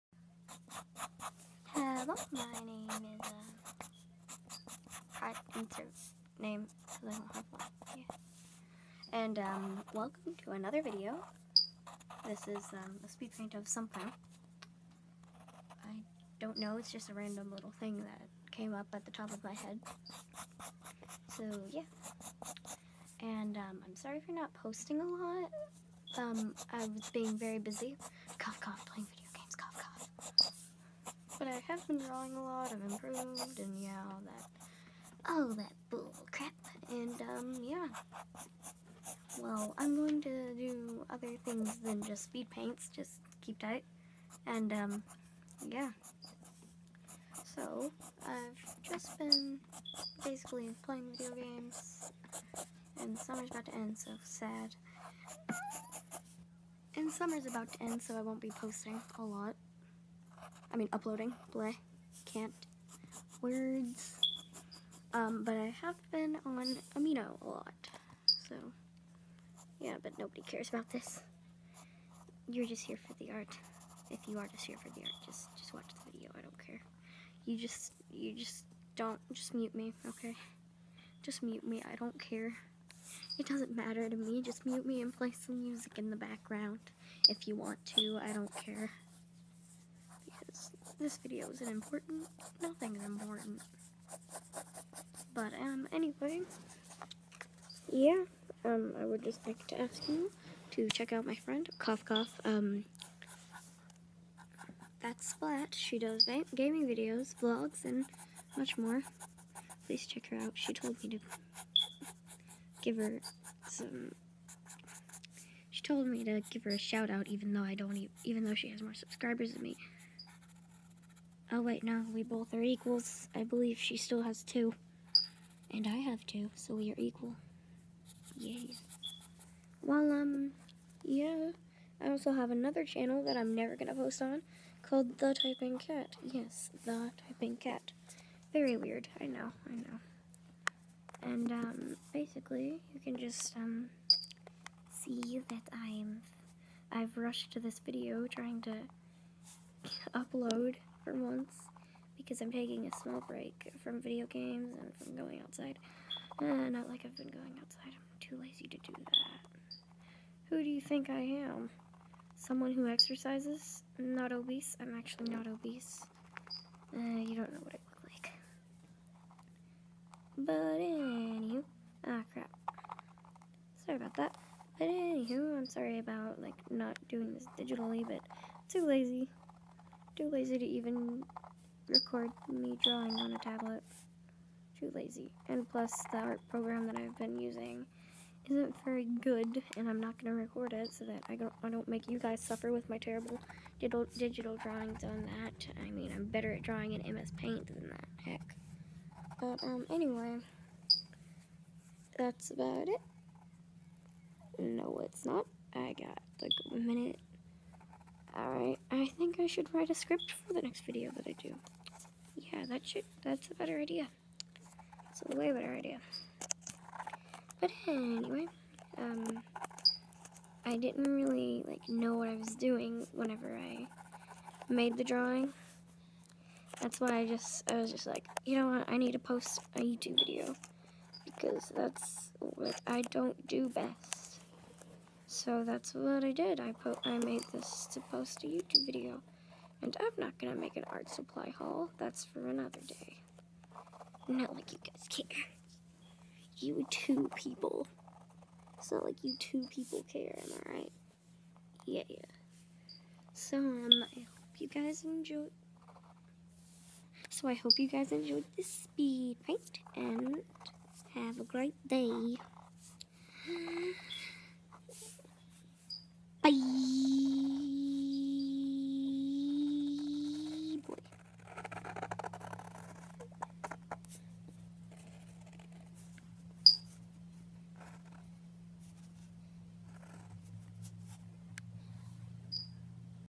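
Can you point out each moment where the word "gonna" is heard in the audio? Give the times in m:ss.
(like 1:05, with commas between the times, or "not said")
2:13, 4:00.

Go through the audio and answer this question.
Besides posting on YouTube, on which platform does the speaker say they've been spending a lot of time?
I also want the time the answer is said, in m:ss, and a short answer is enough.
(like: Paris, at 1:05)
Amino, at 1:06.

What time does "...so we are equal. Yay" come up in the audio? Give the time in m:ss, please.
2:06.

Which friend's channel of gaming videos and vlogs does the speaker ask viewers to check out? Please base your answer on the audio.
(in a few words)
Splat.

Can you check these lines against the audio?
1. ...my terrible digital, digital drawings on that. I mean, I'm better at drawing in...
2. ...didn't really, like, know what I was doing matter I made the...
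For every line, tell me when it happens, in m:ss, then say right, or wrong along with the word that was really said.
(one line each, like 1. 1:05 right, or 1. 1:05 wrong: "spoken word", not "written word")
1. 3:12 right
2. 3:40 wrong: "whenever", not "matter".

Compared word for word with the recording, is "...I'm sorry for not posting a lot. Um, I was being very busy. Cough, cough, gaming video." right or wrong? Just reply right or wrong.
wrong.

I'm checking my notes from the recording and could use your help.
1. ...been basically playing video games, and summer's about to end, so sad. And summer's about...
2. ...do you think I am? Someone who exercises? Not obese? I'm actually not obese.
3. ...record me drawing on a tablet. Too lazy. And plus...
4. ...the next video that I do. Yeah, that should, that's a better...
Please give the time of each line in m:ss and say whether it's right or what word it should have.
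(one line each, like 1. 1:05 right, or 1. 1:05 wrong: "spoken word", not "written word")
1. 0:49 right
2. 2:40 right
3. 3:01 right
4. 3:30 right.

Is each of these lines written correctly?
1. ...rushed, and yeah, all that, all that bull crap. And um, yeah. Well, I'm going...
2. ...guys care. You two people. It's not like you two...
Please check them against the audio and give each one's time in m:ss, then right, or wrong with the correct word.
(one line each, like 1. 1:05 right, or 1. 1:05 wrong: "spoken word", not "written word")
1. 0:32 wrong: "improved", not "rushed"
2. 4:04 right.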